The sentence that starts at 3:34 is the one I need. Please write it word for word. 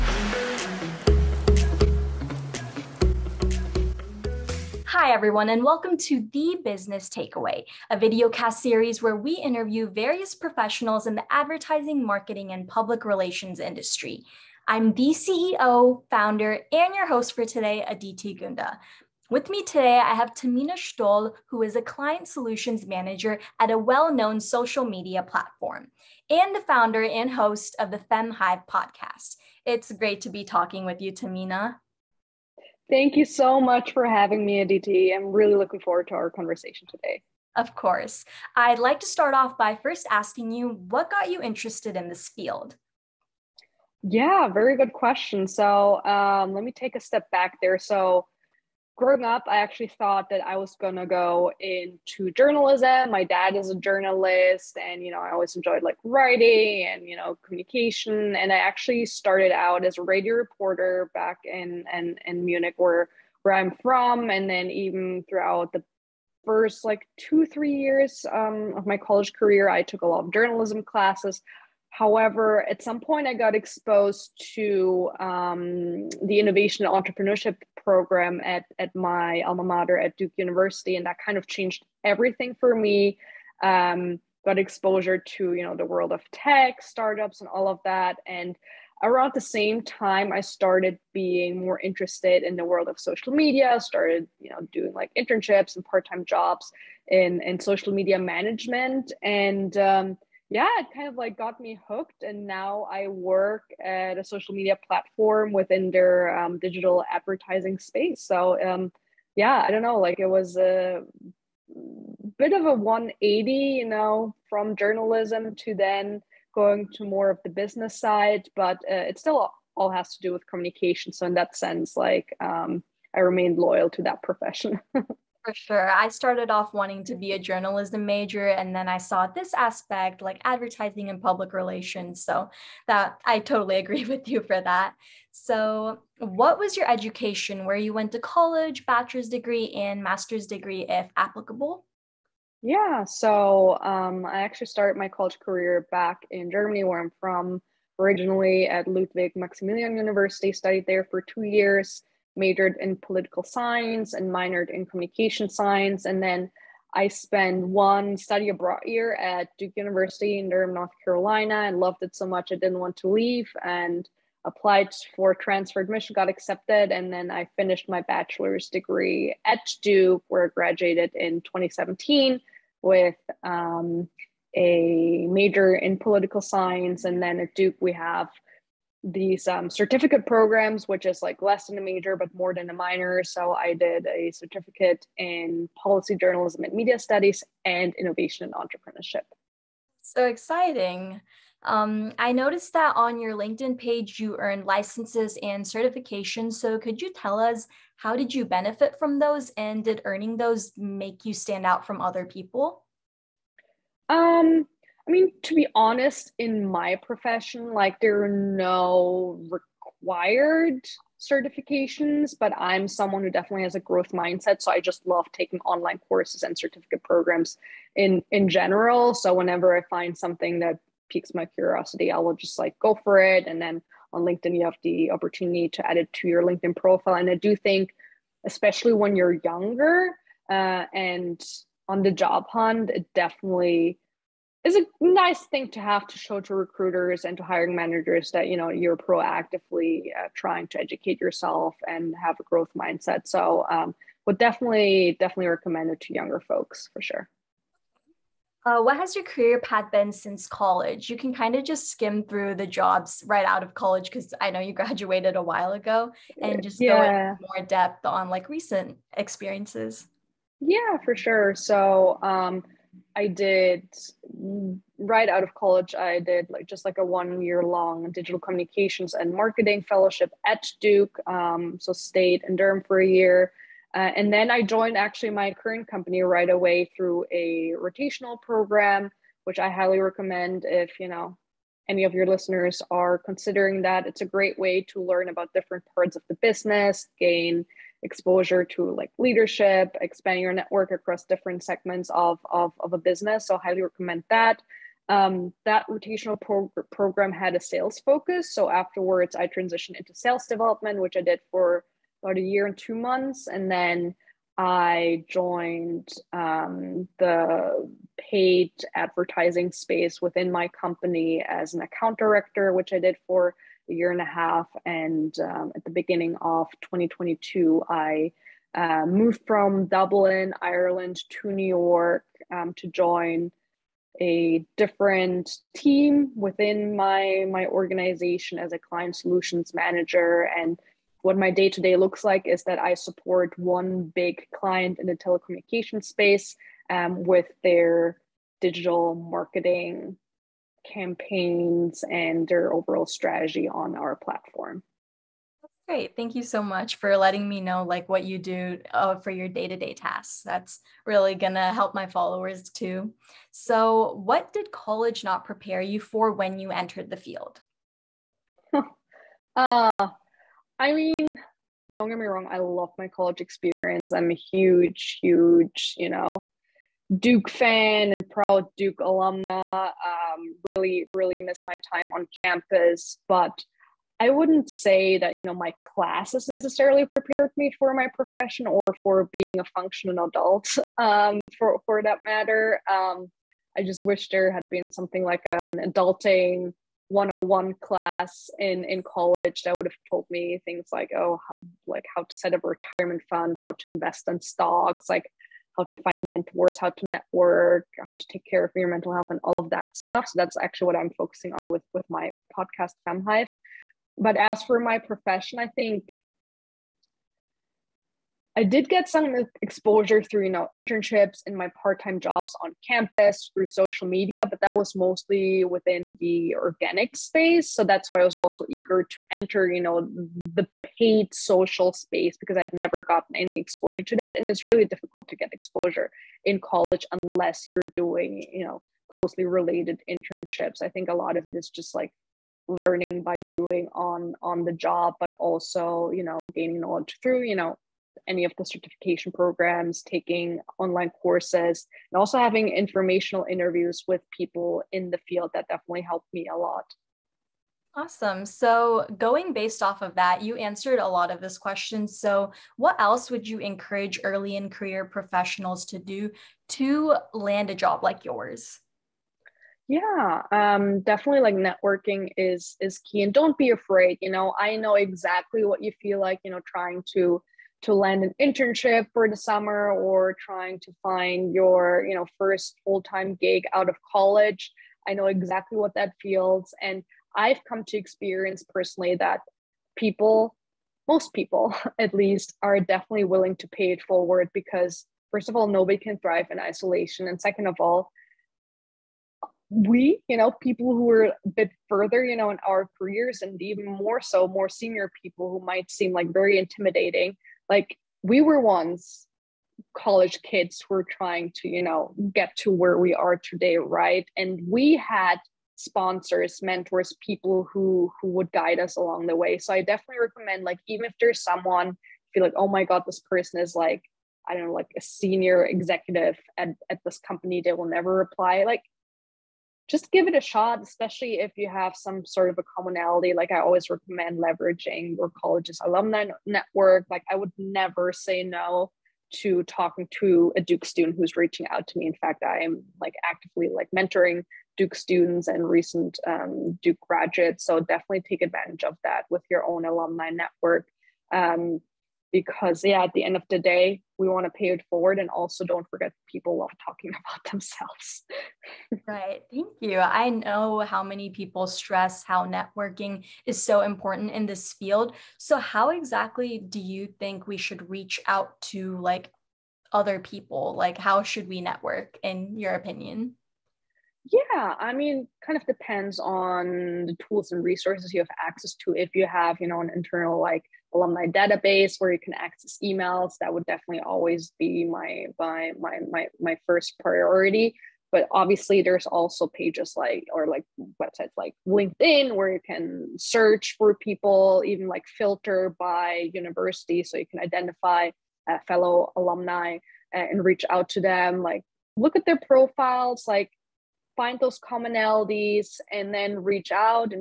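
So I just love taking online courses and certificate programs in in general.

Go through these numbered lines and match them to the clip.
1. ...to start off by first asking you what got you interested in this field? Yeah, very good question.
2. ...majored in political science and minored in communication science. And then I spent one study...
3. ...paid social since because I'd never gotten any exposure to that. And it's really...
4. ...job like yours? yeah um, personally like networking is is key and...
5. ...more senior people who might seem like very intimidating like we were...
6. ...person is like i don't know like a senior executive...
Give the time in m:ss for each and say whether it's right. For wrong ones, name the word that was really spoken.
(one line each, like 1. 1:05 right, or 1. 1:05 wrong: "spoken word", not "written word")
1. 0:39 right
2. 2:32 right
3. 7:00 wrong: "space", not "since"
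4. 7:37 wrong: "definitely", not "personally"
5. 8:14 right
6. 8:33 right.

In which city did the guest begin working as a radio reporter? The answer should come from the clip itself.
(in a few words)
Munich.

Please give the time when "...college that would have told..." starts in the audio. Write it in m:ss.
6:29.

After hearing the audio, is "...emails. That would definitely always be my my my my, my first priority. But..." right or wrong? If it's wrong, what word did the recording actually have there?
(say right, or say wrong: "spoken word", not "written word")
right.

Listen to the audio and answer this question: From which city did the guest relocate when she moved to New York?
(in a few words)
Dublin.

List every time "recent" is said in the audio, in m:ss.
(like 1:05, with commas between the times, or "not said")
4:18, 8:55.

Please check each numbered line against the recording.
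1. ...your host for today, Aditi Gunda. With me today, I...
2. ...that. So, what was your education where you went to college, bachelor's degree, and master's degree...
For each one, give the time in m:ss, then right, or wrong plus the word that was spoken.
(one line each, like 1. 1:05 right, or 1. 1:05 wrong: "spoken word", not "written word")
1. 0:16 right
2. 2:14 right.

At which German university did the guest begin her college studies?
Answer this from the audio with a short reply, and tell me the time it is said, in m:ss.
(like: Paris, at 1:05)
Ludwig Maximilian University, at 2:28.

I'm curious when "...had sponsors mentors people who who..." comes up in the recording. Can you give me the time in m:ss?
8:24.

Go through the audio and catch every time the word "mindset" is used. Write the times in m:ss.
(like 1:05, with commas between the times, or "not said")
3:34, 4:02.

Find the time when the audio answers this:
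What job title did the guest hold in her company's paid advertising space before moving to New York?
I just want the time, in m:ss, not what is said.
5:11.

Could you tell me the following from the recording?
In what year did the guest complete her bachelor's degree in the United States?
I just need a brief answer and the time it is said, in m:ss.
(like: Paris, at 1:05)
2017, at 2:51.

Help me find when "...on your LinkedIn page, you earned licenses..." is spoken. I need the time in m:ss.
3:12.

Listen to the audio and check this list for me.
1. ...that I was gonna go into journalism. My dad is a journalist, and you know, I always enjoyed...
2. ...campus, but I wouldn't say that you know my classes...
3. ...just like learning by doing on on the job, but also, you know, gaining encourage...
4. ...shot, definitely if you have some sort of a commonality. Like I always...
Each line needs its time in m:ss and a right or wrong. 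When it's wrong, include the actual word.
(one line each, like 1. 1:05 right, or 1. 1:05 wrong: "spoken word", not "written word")
1. 0:50 right
2. 6:12 right
3. 7:11 wrong: "knowledge", not "encourage"
4. 8:40 wrong: "especially", not "definitely".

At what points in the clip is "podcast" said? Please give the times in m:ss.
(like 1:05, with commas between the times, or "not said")
0:28, 6:42.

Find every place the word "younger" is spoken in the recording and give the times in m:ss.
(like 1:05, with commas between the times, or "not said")
3:49, 4:06.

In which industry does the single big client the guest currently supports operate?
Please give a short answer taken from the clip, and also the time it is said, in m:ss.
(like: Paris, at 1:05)
telecommunication, at 5:35.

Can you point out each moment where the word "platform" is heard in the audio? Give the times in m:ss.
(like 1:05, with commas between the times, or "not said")
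0:25, 1:44, 5:44.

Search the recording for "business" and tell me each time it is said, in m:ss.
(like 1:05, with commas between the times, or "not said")
0:06, 1:57, 4:46, 4:52.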